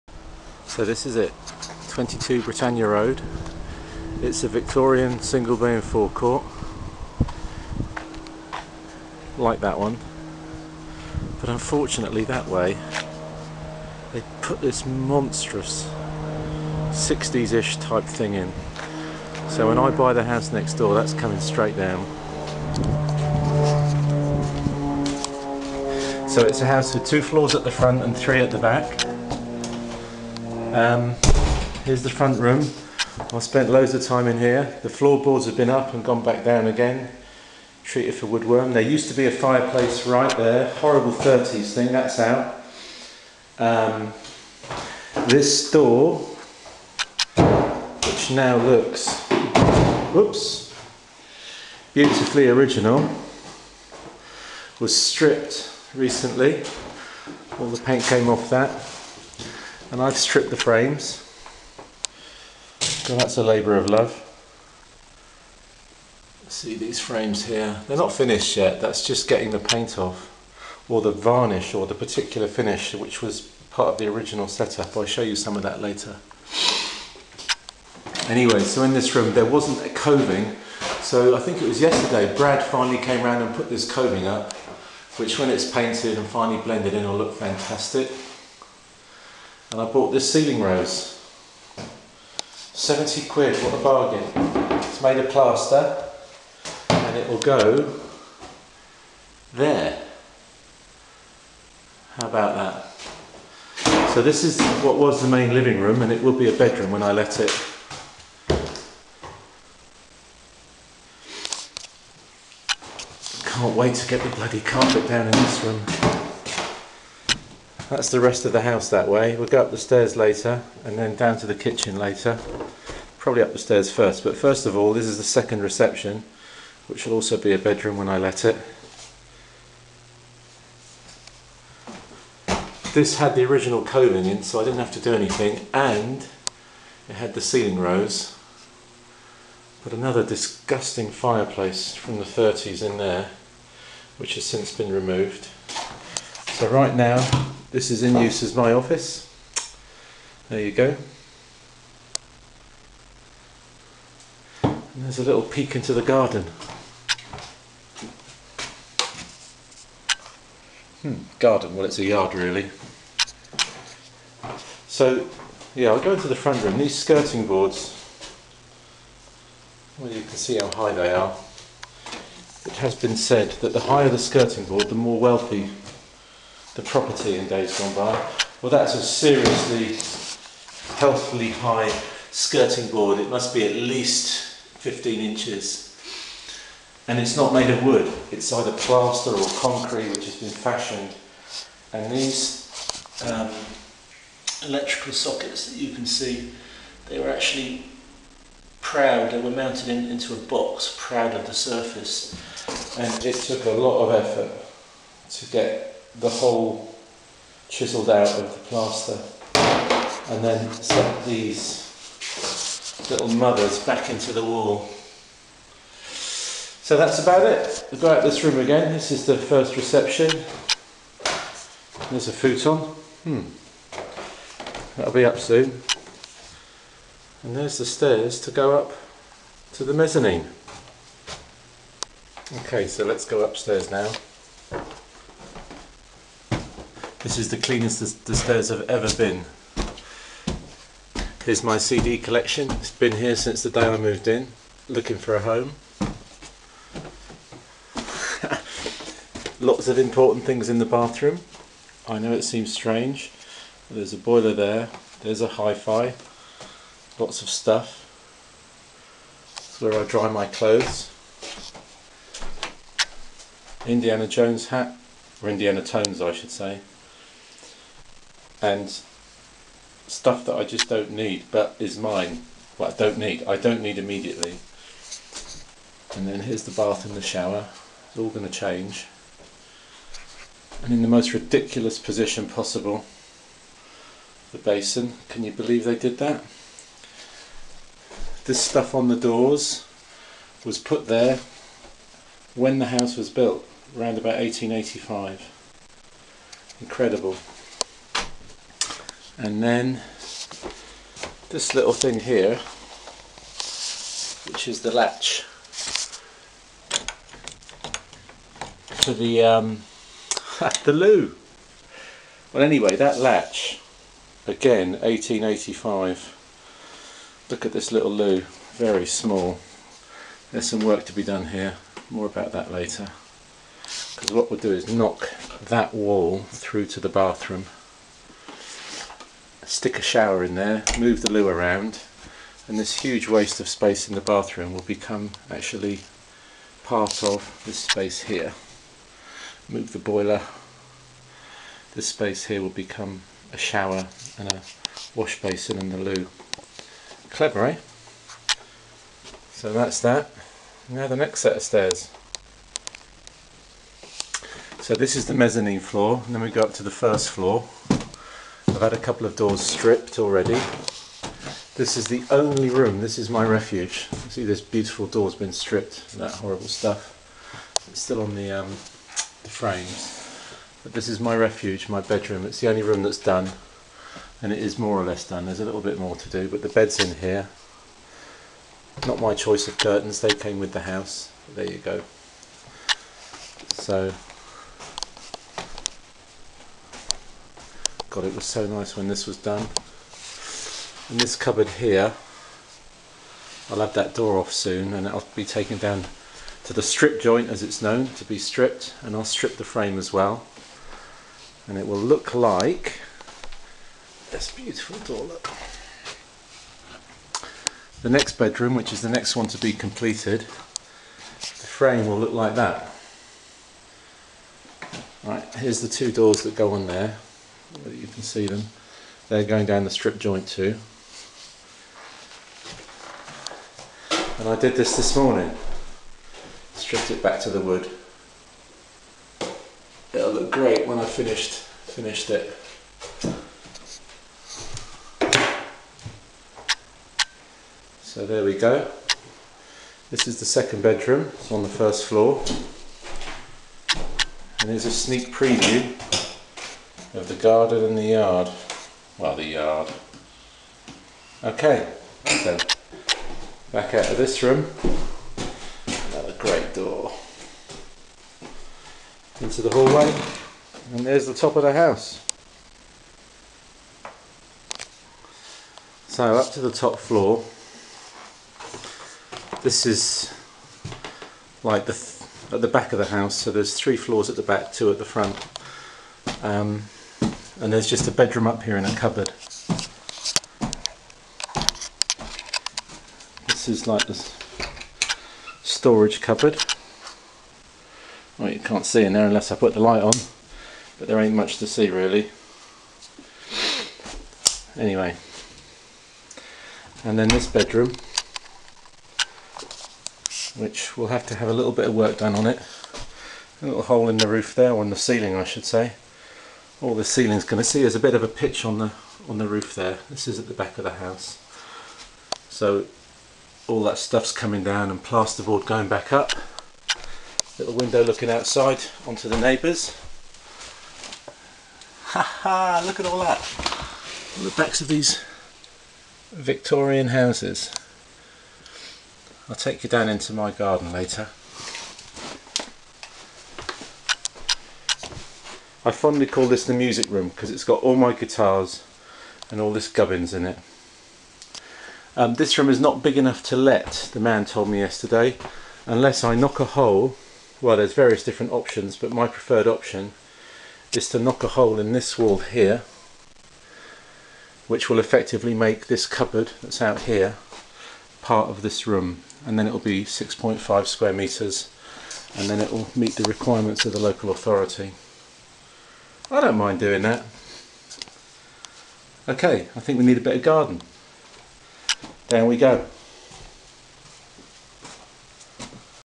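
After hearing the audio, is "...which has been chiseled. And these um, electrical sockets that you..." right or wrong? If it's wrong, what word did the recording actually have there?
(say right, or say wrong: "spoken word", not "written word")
wrong: "fashioned", not "chiseled".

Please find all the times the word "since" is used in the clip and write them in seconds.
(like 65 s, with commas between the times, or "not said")
144 s, 243 s.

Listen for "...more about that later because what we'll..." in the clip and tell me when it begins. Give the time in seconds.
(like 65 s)
322 s.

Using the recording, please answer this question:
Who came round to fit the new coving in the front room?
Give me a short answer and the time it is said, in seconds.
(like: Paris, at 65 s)
Brad, at 82 s.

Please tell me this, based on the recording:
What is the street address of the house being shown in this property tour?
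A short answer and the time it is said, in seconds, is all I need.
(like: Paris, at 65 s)
22 Britannia Road, at 1 s.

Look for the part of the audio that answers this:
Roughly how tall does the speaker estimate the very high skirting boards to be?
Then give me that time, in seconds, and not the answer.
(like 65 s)
184 s.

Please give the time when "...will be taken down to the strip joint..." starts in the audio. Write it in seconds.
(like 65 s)
395 s.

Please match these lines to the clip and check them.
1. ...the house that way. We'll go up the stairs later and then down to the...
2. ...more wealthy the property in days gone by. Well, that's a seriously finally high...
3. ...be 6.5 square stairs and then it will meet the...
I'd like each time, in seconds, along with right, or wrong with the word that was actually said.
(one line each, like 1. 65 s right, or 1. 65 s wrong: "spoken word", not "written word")
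1. 118 s right
2. 174 s wrong: "healthily", not "finally"
3. 559 s wrong: "meters", not "stairs".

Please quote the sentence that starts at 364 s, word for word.
See this beautiful door's been stripped, that horrible stuff.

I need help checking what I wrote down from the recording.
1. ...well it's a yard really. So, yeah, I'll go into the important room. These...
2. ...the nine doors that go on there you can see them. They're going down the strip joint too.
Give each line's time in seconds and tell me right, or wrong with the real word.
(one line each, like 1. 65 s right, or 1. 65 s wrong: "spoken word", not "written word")
1. 161 s wrong: "front", not "important"
2. 415 s wrong: "two", not "nine".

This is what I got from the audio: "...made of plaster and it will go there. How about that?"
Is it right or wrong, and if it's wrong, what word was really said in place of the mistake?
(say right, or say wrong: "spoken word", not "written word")
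right.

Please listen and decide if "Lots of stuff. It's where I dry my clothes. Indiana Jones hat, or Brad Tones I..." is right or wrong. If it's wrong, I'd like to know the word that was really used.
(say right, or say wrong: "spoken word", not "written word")
wrong: "Indiana", not "Brad".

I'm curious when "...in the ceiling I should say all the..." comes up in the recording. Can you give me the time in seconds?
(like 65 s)
504 s.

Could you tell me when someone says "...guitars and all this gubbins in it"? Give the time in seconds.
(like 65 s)
538 s.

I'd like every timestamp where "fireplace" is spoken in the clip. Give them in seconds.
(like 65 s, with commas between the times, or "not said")
39 s, 141 s.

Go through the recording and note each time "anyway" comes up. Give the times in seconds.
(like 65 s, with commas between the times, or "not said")
78 s, 312 s, 494 s.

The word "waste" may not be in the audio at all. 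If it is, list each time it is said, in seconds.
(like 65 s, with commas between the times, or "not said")
333 s.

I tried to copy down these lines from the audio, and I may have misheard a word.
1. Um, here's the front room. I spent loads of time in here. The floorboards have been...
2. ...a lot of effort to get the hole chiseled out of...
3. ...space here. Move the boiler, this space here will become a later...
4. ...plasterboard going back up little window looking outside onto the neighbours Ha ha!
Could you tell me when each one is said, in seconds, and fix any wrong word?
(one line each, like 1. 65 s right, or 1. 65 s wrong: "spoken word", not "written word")
1. 30 s right
2. 203 s right
3. 337 s wrong: "shower", not "later"
4. 515 s right.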